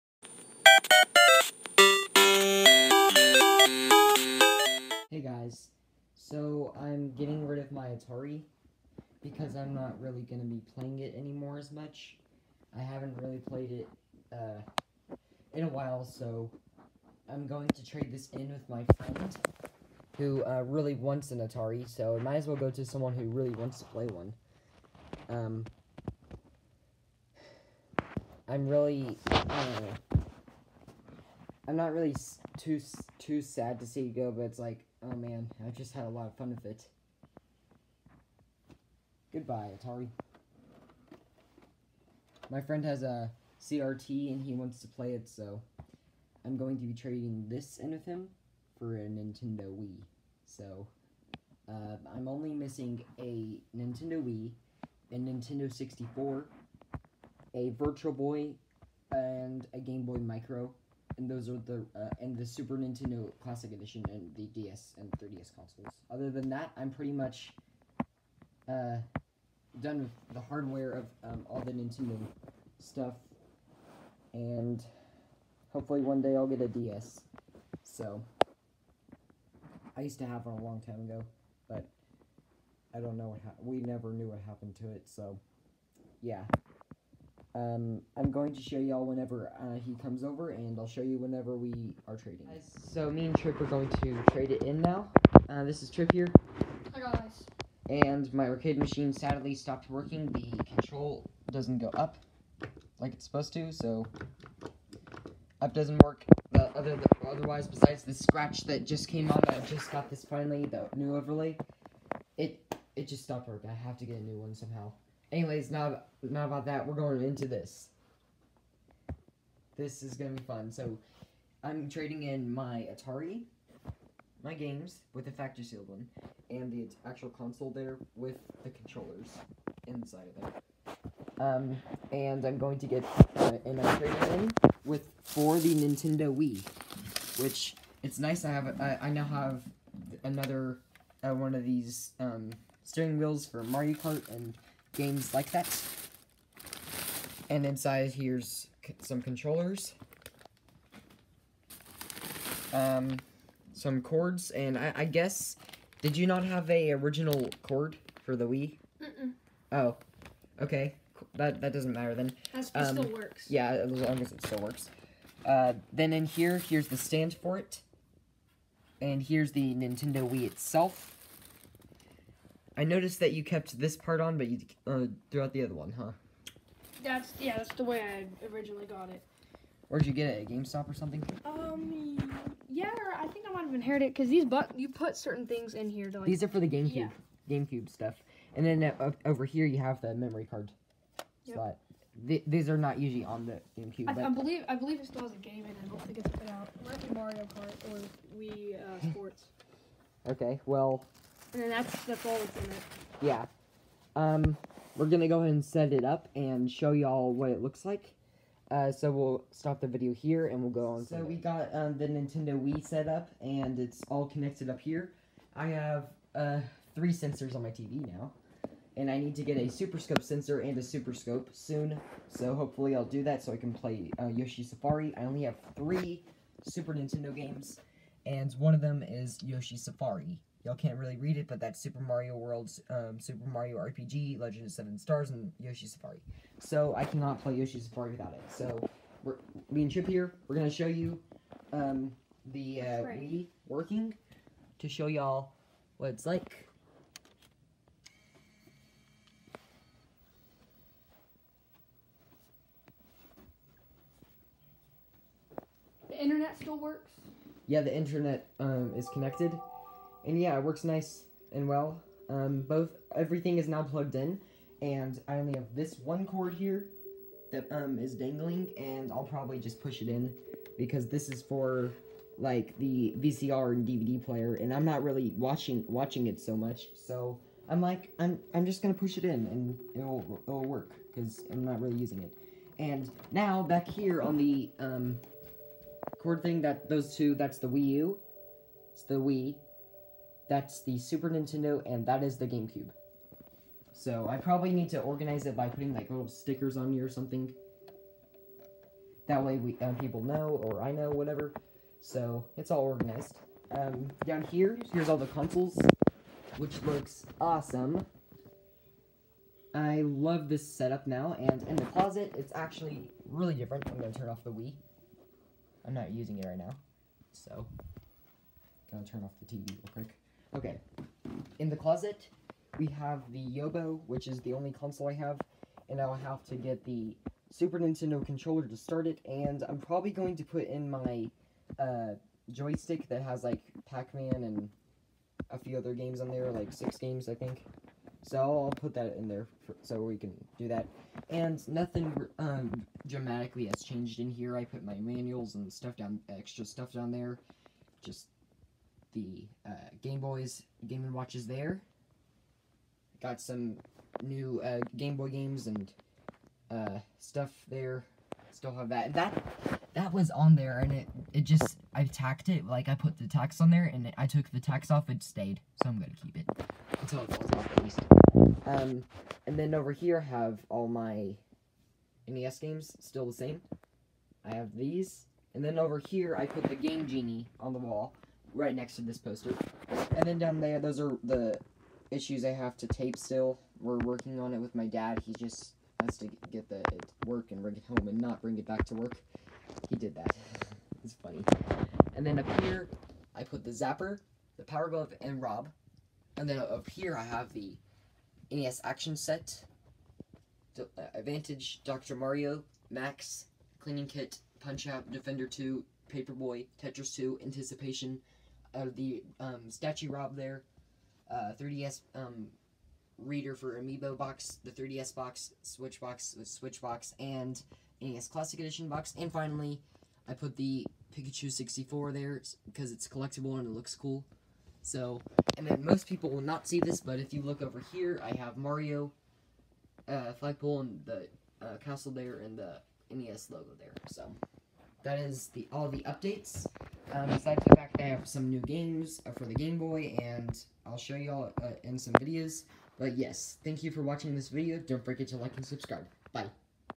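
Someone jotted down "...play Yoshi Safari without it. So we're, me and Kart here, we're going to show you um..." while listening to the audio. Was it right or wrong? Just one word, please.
wrong.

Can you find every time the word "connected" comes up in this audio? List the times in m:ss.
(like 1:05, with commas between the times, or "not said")
3:34, 4:19.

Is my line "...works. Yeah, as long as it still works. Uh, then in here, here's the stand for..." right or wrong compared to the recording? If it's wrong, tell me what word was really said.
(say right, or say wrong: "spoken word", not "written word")
right.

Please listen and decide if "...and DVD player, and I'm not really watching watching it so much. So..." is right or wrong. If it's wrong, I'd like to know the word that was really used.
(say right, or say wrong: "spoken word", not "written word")
right.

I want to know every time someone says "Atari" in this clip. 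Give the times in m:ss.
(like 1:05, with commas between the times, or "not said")
0:07, 0:21, 0:39, 2:02.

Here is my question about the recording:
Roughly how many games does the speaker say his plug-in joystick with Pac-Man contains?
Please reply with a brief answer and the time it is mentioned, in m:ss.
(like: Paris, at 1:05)
6, at 5:36.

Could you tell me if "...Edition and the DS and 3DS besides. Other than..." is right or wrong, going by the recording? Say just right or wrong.
wrong.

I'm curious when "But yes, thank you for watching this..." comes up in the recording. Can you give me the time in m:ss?
7:22.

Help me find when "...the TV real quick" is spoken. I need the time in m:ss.
5:19.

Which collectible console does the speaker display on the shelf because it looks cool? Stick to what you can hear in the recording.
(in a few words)
Pikachu 64.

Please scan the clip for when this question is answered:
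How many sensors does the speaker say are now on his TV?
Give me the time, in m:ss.
3:36.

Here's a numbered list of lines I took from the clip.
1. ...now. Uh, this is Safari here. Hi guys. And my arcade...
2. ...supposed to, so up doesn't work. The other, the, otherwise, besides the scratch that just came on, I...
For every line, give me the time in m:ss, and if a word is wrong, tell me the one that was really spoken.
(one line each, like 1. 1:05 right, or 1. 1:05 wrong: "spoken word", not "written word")
1. 1:34 wrong: "Trip", not "Safari"
2. 1:43 right.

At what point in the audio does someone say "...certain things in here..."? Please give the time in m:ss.
3:05.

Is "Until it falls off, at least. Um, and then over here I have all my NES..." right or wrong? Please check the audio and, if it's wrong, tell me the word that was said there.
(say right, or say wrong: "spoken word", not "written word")
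right.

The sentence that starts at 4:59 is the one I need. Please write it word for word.
That way we um, people know, or I know, whatever.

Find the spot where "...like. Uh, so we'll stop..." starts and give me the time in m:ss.
3:27.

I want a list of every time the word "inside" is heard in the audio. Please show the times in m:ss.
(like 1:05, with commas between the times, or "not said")
2:09, 2:27.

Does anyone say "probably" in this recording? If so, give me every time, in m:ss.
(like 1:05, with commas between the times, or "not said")
4:29, 4:54, 5:29.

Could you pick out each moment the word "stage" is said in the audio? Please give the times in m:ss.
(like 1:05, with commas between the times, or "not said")
not said.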